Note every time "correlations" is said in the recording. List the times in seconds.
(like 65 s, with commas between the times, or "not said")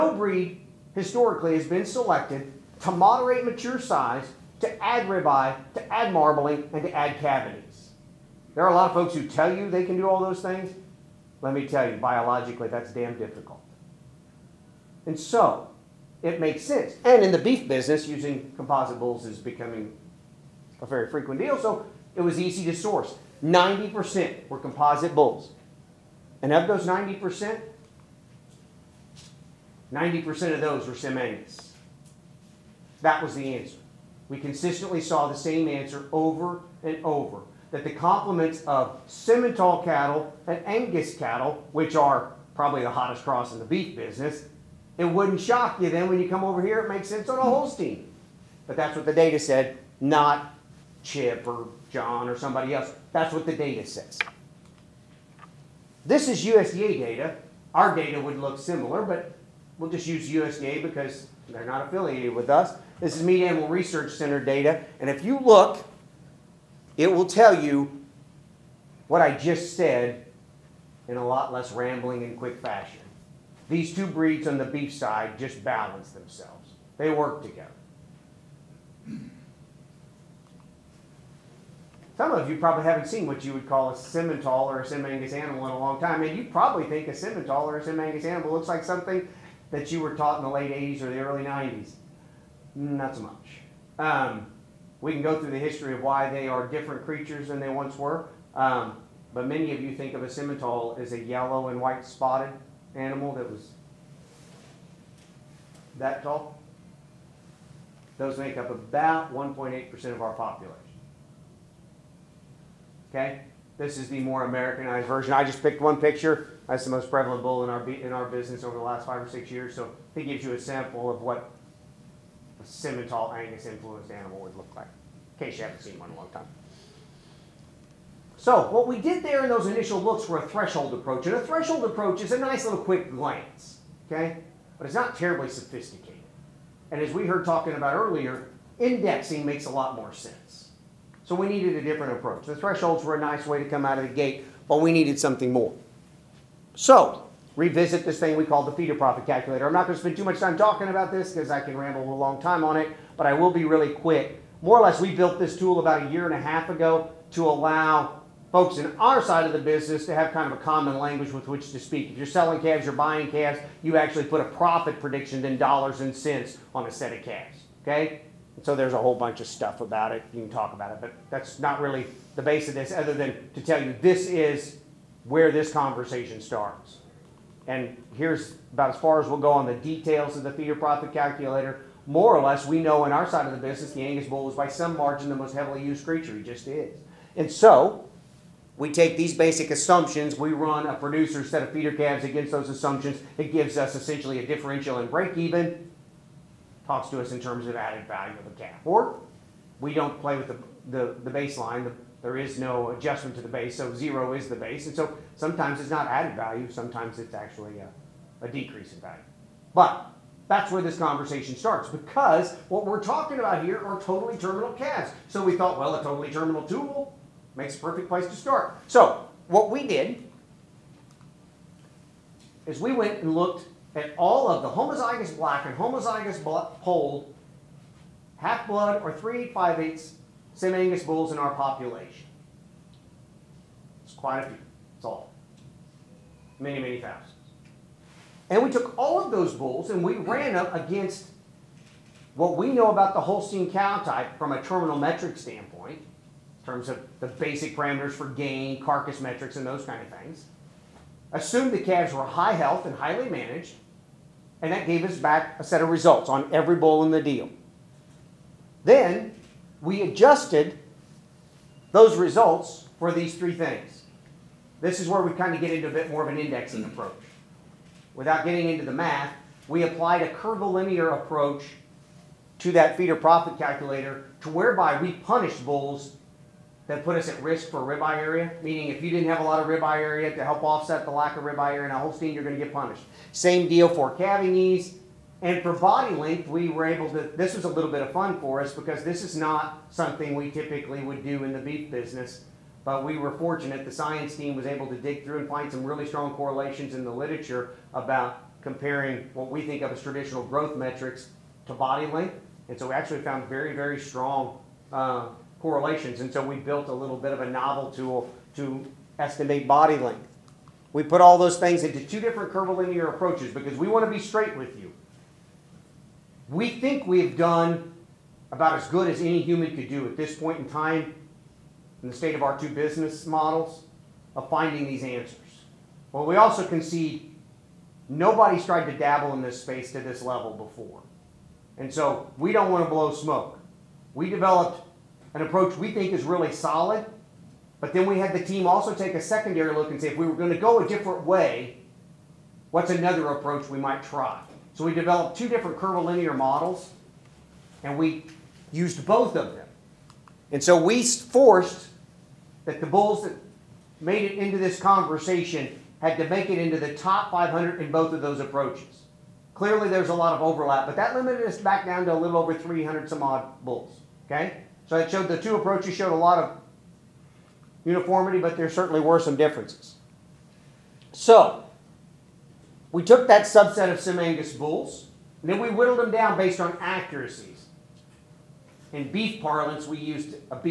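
296 s, 305 s.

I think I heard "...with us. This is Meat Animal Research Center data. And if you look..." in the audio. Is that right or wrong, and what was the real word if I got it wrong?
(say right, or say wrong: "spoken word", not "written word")
right.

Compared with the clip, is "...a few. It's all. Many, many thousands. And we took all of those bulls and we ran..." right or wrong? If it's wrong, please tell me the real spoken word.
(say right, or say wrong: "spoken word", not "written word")
right.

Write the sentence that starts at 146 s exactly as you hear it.
So revisit this thing we call the feeder profit calculator.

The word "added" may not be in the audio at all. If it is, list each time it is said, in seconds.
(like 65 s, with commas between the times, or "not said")
197 s, 206 s.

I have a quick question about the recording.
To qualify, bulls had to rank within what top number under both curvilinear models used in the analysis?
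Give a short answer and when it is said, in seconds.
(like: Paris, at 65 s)
top 500, at 356 s.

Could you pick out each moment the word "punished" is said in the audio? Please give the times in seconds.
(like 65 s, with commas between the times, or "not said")
275 s, 282 s.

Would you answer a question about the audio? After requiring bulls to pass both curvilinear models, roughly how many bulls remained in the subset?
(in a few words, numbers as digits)
a little over 300.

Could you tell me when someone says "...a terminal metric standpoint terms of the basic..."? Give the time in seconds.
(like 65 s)
244 s.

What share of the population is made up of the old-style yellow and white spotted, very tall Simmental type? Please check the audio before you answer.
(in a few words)
1.8%.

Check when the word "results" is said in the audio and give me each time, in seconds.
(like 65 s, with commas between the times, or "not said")
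255 s, 262 s.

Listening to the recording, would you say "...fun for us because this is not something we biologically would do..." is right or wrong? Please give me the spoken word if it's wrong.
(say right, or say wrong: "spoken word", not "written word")
wrong: "typically", not "biologically".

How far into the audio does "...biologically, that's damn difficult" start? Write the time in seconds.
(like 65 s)
11 s.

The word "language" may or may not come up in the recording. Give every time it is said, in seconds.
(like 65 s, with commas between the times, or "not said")
160 s.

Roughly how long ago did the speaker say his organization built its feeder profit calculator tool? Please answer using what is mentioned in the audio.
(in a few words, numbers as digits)
a year and a half.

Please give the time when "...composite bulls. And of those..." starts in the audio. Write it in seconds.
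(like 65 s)
24 s.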